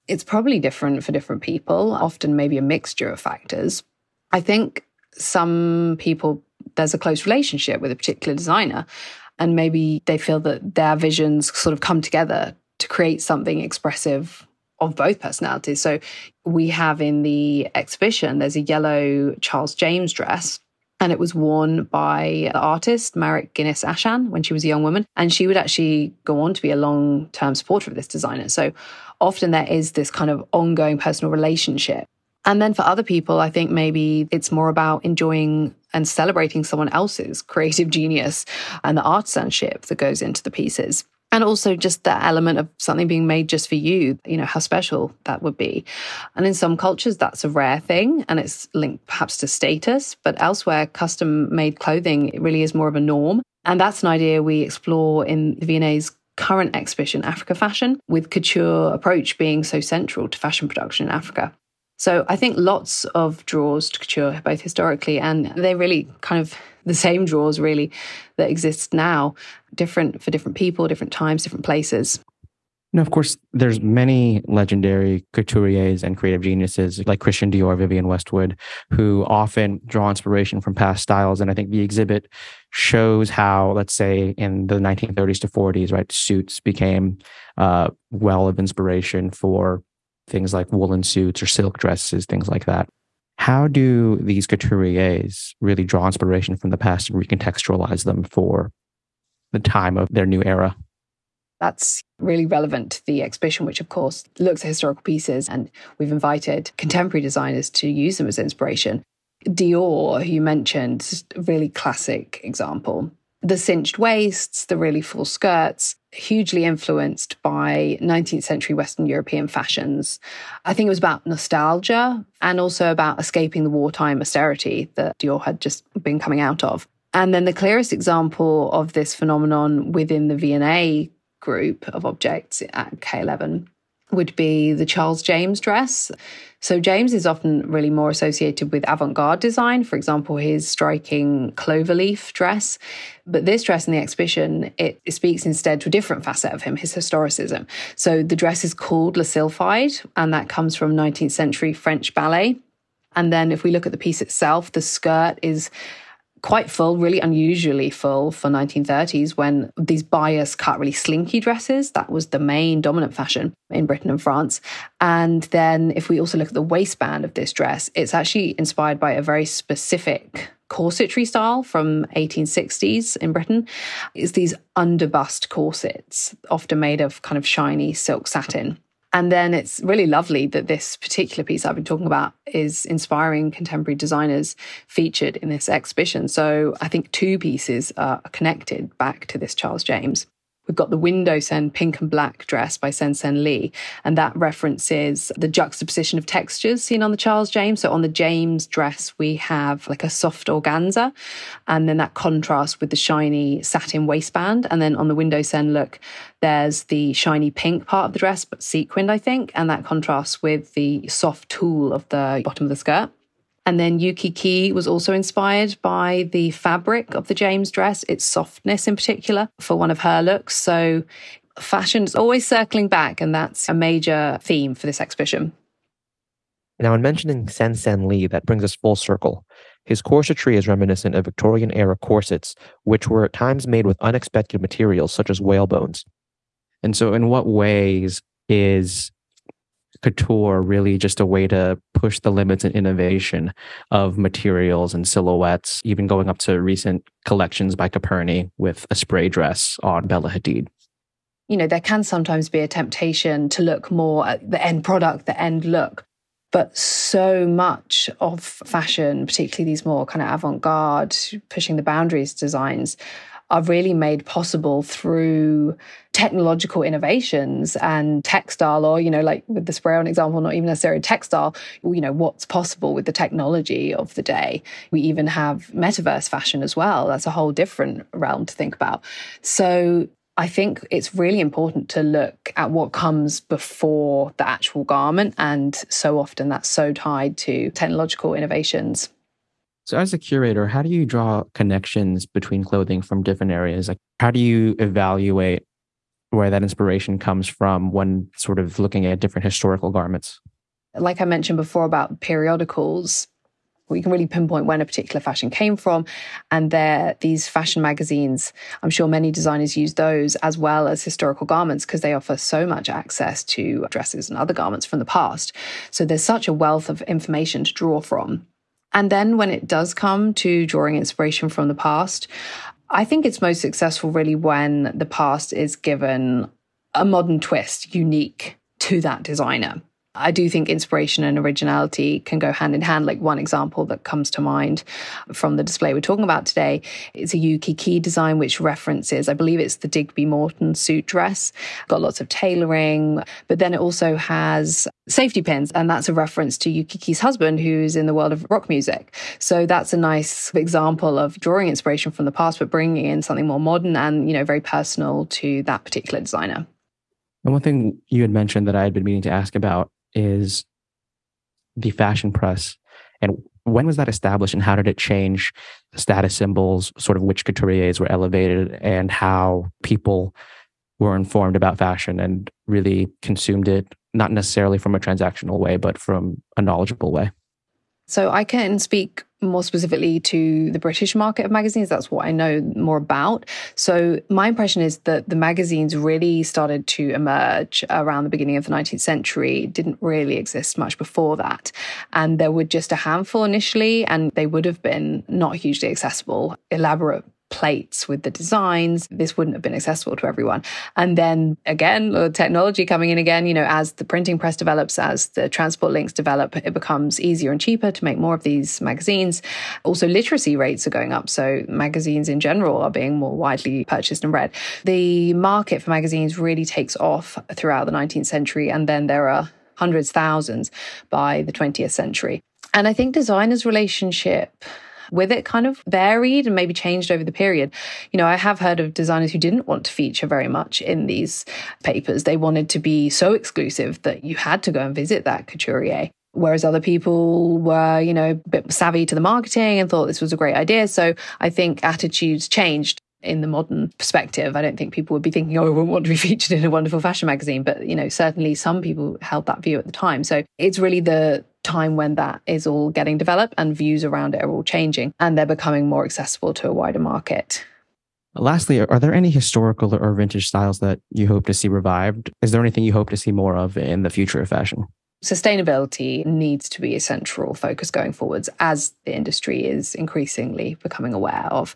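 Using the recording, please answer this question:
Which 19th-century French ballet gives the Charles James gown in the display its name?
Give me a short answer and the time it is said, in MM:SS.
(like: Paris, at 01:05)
Le Sylphide, at 02:29.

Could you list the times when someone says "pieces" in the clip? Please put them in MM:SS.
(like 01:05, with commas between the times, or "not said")
00:40, 01:45, 02:34, 03:01, 03:07.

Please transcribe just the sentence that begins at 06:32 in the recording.
And there were just a handful initially, and they would have been not hugely accessible, elaborate plates with the designs.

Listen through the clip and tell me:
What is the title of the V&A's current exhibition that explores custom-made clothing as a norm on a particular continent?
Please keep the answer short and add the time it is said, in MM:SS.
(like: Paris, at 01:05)
Africa Fashion, at 00:57.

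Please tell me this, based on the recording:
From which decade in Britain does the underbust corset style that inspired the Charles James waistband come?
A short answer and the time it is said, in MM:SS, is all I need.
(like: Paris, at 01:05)
1860s, at 02:52.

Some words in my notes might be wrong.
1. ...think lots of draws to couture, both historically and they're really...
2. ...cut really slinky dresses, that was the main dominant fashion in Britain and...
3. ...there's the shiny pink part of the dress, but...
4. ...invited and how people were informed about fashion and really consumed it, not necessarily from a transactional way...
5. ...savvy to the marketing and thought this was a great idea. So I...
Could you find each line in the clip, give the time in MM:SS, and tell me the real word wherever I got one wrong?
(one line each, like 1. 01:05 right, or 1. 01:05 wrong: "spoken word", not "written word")
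1. 01:02 right
2. 02:40 right
3. 03:26 right
4. 06:08 wrong: "elevated", not "invited"
5. 07:18 right.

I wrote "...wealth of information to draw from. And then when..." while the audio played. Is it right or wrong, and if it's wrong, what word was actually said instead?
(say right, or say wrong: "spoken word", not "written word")
right.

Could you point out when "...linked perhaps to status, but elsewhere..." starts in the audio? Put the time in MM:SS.
00:48.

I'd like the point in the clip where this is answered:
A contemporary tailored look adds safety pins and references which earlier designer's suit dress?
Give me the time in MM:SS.
05:39.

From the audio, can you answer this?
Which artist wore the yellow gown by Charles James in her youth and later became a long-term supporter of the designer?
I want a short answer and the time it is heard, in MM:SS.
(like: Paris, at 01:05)
Marit Guinness Aschan, at 00:23.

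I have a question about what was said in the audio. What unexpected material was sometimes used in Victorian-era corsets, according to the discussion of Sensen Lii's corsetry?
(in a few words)
Whalebones.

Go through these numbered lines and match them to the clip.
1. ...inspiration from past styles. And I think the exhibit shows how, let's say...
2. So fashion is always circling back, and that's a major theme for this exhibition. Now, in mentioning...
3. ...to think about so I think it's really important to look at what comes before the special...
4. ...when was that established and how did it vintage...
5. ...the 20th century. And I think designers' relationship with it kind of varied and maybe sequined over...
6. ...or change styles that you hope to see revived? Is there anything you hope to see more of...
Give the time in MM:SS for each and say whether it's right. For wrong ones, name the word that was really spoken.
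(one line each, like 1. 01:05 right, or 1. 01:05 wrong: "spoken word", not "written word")
1. 01:20 right
2. 03:40 right
3. 04:38 wrong: "actual", not "special"
4. 06:03 wrong: "change", not "vintage"
5. 07:01 wrong: "changed", not "sequined"
6. 07:39 wrong: "vintage", not "change".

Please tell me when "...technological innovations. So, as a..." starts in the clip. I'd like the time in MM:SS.
04:47.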